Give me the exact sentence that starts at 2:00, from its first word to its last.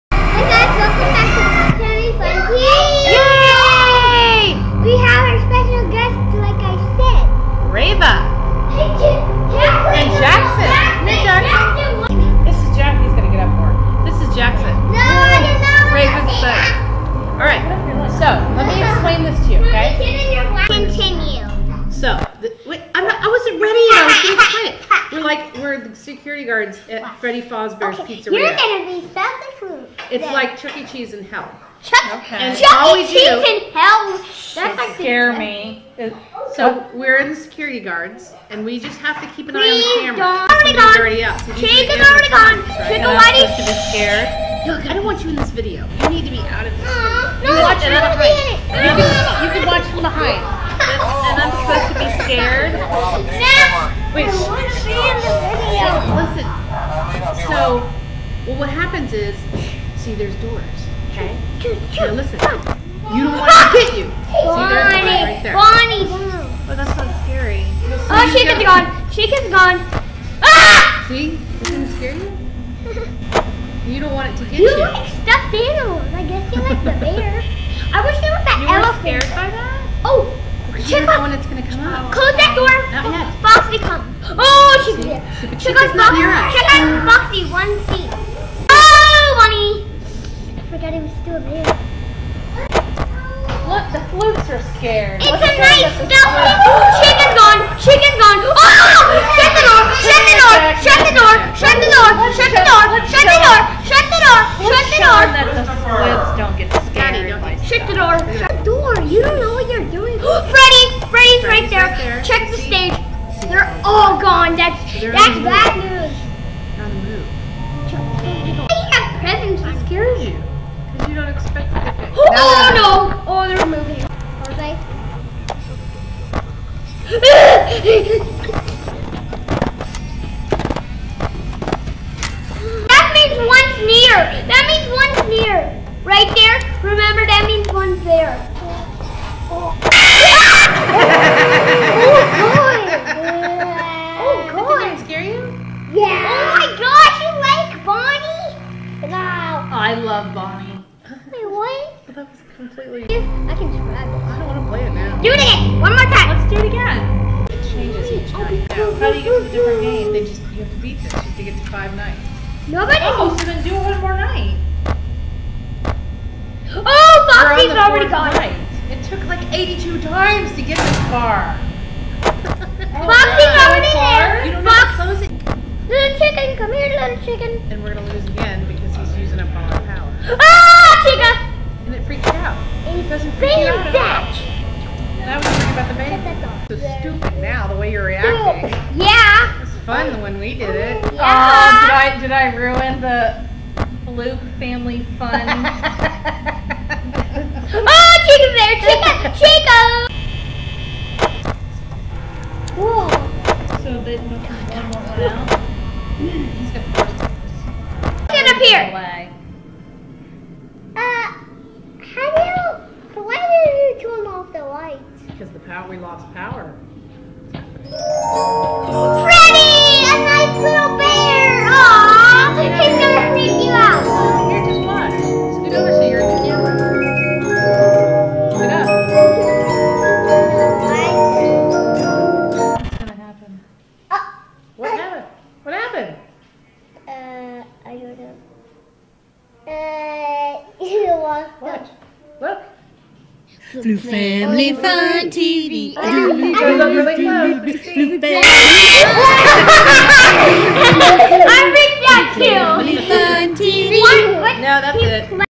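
Because you don't expect oh, it to Oh, oh no!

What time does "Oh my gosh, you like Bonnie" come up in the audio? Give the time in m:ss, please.
2:26.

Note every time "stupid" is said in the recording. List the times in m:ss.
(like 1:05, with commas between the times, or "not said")
3:06.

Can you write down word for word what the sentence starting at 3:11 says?
Oh, did I did I ruin the Fluke family fun?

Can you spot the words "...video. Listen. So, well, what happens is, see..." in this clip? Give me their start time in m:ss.
0:55.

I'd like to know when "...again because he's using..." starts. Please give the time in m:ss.
2:58.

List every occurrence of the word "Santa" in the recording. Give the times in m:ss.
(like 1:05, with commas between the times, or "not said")
0:29.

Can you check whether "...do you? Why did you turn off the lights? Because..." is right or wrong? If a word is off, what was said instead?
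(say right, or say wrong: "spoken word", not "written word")
right.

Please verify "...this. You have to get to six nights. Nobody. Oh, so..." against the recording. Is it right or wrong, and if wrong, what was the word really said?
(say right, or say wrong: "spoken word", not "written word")
wrong: "five", not "six".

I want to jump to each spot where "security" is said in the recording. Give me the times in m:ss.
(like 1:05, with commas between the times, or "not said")
0:26, 0:37.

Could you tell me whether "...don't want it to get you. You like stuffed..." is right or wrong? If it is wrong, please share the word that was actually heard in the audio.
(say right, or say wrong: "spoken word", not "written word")
right.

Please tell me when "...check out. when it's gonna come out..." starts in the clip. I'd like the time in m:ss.
1:20.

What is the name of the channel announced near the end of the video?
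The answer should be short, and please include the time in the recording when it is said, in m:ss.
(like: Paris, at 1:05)
Fluke Family Fun TV, at 4:03.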